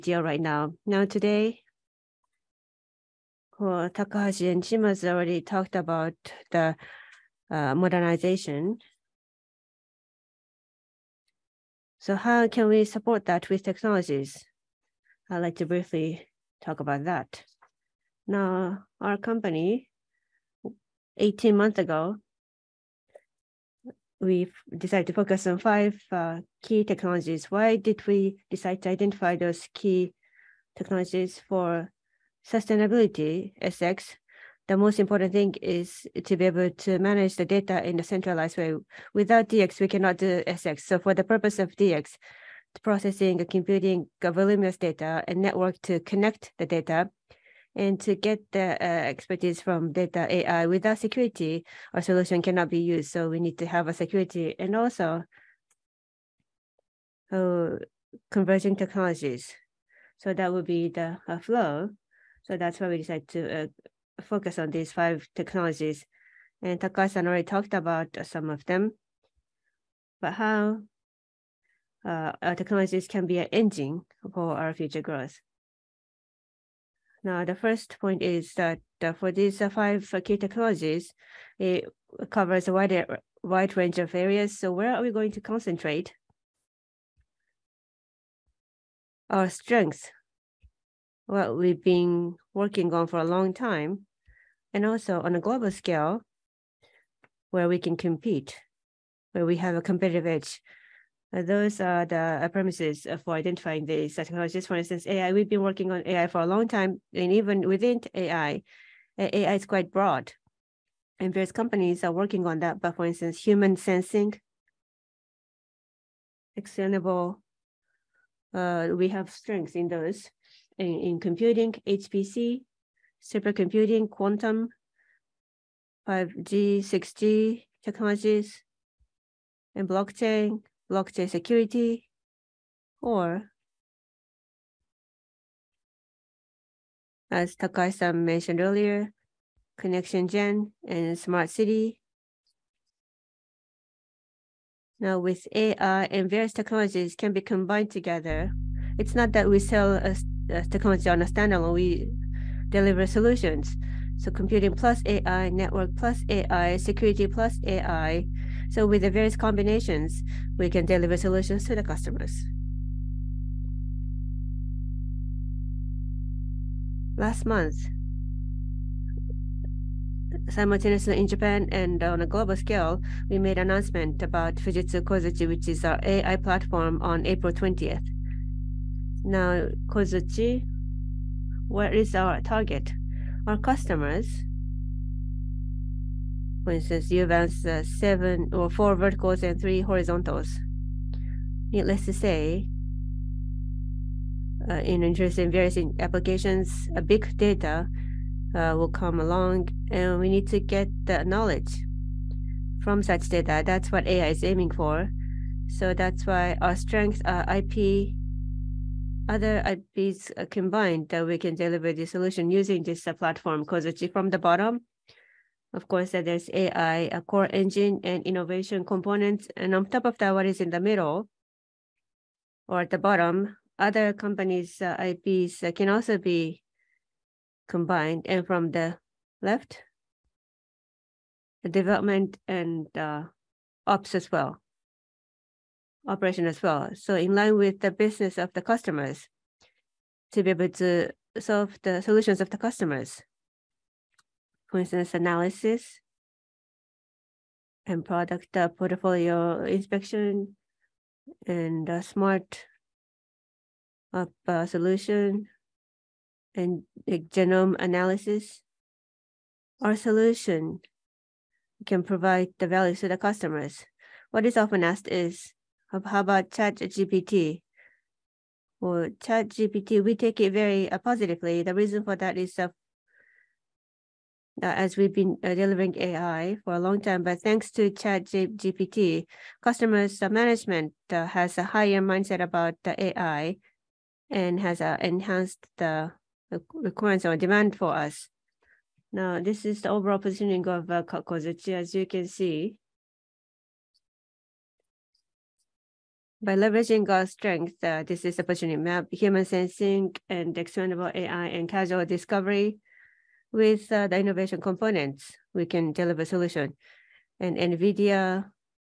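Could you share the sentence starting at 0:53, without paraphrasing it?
So we need to have a security and also uh, converging technologies.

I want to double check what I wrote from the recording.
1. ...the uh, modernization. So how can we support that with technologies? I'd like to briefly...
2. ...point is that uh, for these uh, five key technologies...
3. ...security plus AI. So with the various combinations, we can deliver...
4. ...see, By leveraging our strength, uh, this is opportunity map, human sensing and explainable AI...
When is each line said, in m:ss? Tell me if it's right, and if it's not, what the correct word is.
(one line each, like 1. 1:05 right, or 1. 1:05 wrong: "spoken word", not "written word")
1. 0:06 right
2. 1:17 right
3. 2:36 right
4. 4:52 right.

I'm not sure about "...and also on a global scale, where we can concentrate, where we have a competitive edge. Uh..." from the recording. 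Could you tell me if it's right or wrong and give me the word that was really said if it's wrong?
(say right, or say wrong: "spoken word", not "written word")
wrong: "compete", not "concentrate".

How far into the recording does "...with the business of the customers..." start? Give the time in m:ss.
3:57.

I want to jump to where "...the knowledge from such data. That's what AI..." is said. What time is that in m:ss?
3:21.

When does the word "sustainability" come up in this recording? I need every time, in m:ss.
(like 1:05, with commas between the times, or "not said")
0:32.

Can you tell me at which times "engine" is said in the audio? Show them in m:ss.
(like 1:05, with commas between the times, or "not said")
1:13, 3:37.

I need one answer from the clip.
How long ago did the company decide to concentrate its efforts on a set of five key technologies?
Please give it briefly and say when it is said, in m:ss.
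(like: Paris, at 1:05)
18 months, at 0:21.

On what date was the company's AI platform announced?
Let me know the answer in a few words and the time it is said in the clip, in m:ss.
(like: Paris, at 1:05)
April 20th, at 2:57.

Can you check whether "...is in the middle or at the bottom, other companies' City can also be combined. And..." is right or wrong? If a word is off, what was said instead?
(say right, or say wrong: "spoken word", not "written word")
wrong: "IPs", not "City".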